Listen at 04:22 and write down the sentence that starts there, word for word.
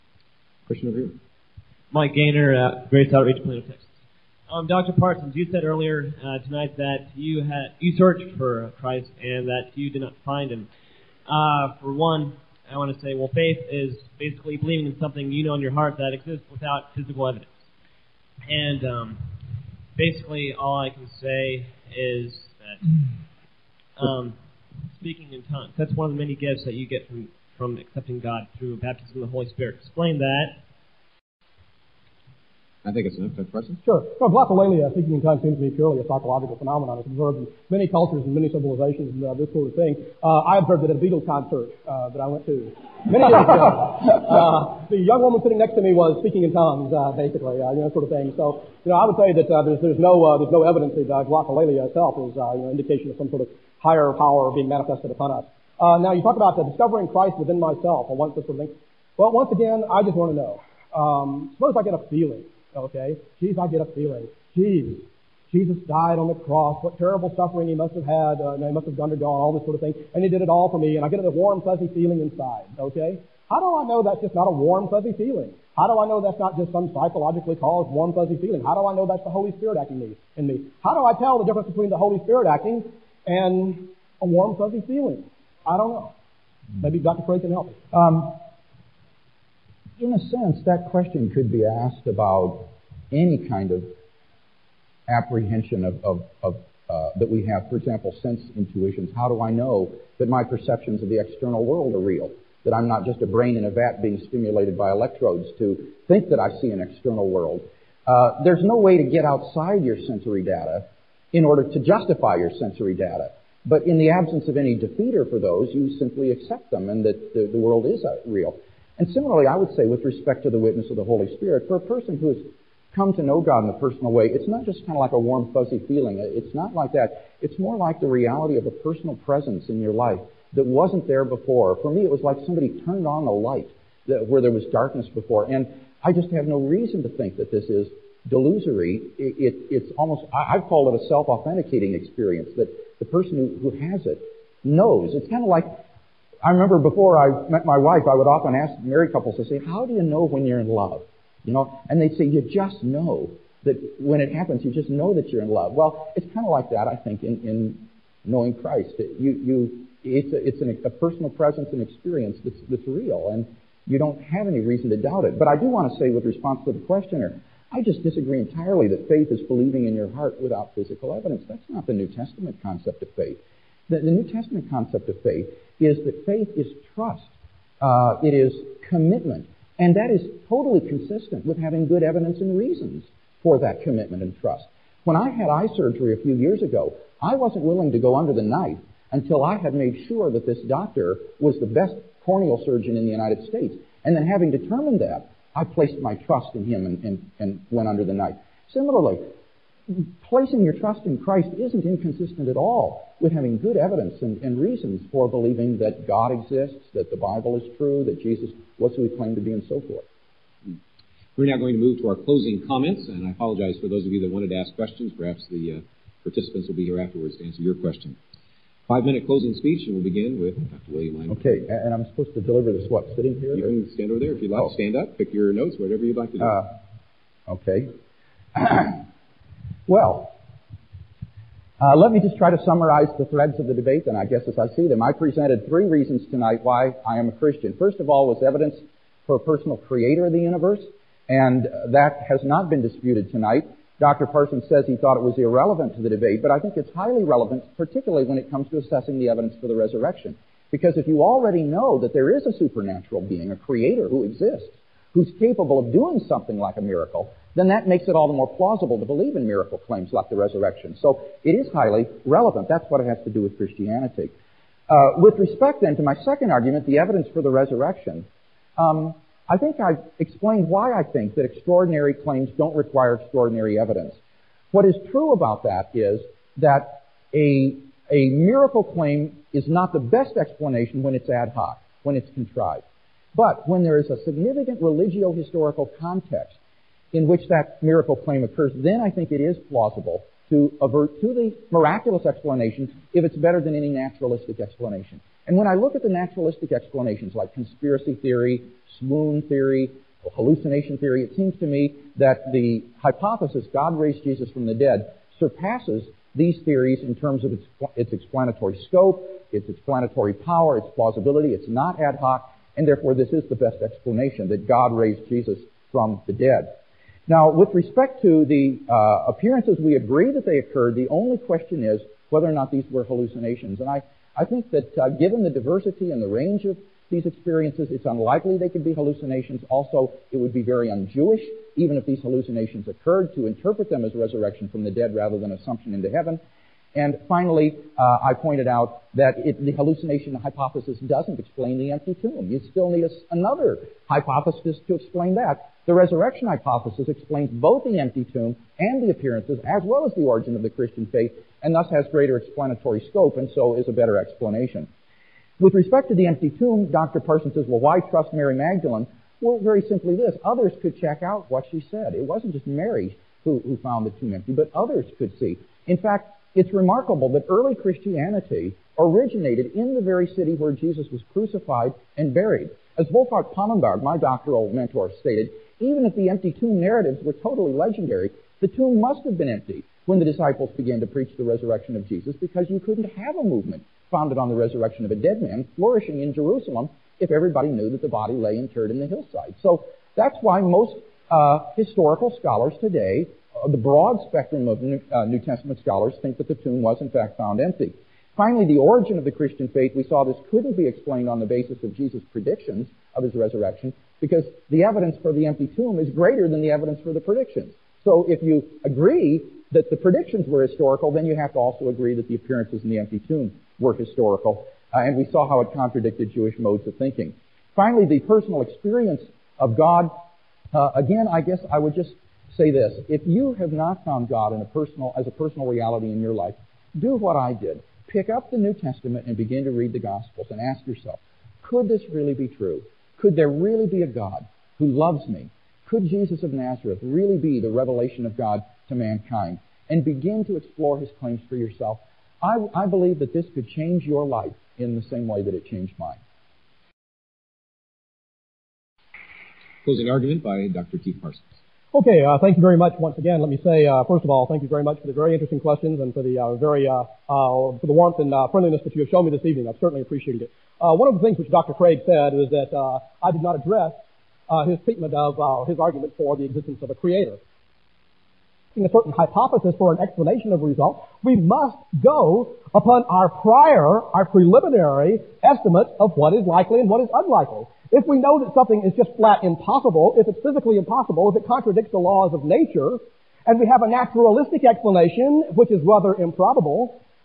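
That's what it has to do with Christianity.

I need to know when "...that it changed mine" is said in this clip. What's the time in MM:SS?
07:25.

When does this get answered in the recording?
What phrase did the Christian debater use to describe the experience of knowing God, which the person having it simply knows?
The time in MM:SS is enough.
02:21.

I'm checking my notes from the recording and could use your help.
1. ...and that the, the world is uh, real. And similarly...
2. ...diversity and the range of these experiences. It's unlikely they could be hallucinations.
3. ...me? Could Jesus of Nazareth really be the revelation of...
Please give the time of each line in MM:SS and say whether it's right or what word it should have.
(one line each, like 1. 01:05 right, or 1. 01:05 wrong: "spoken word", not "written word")
1. 01:56 right
2. 05:25 right
3. 07:15 right.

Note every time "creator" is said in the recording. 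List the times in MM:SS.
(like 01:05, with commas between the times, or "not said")
03:59, 04:13, 07:46.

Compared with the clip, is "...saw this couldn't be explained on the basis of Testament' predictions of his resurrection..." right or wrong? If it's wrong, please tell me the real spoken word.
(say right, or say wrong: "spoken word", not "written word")
wrong: "Jesus", not "Testament".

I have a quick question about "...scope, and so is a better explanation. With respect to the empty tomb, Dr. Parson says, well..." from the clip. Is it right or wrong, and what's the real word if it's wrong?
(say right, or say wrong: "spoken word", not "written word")
right.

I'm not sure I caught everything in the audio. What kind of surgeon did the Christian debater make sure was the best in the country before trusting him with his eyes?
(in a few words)
corneal surgeon.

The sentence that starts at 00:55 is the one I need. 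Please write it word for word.
Uh, now, you talk about the discovering Christ within myself.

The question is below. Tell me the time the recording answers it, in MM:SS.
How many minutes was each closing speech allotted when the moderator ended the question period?
03:38.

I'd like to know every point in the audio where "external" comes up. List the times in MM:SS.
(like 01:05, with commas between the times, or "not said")
01:41, 01:46.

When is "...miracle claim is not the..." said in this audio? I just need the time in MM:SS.
04:38.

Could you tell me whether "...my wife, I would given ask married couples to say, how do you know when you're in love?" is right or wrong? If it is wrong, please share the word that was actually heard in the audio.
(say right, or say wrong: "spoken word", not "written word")
wrong: "often", not "given".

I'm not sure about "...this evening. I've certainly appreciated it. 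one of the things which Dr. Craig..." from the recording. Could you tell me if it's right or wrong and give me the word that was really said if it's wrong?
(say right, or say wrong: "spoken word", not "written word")
right.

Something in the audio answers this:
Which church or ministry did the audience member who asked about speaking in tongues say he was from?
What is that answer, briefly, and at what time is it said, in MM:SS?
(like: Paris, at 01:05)
Grace Outreach, at 00:02.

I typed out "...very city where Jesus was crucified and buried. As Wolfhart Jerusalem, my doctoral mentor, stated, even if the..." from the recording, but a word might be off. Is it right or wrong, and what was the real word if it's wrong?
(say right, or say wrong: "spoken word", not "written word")
wrong: "Pannenberg", not "Jerusalem".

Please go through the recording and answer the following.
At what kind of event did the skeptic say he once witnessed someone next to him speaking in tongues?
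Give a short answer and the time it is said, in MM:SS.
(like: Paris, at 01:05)
a Beatles concert, at 00:41.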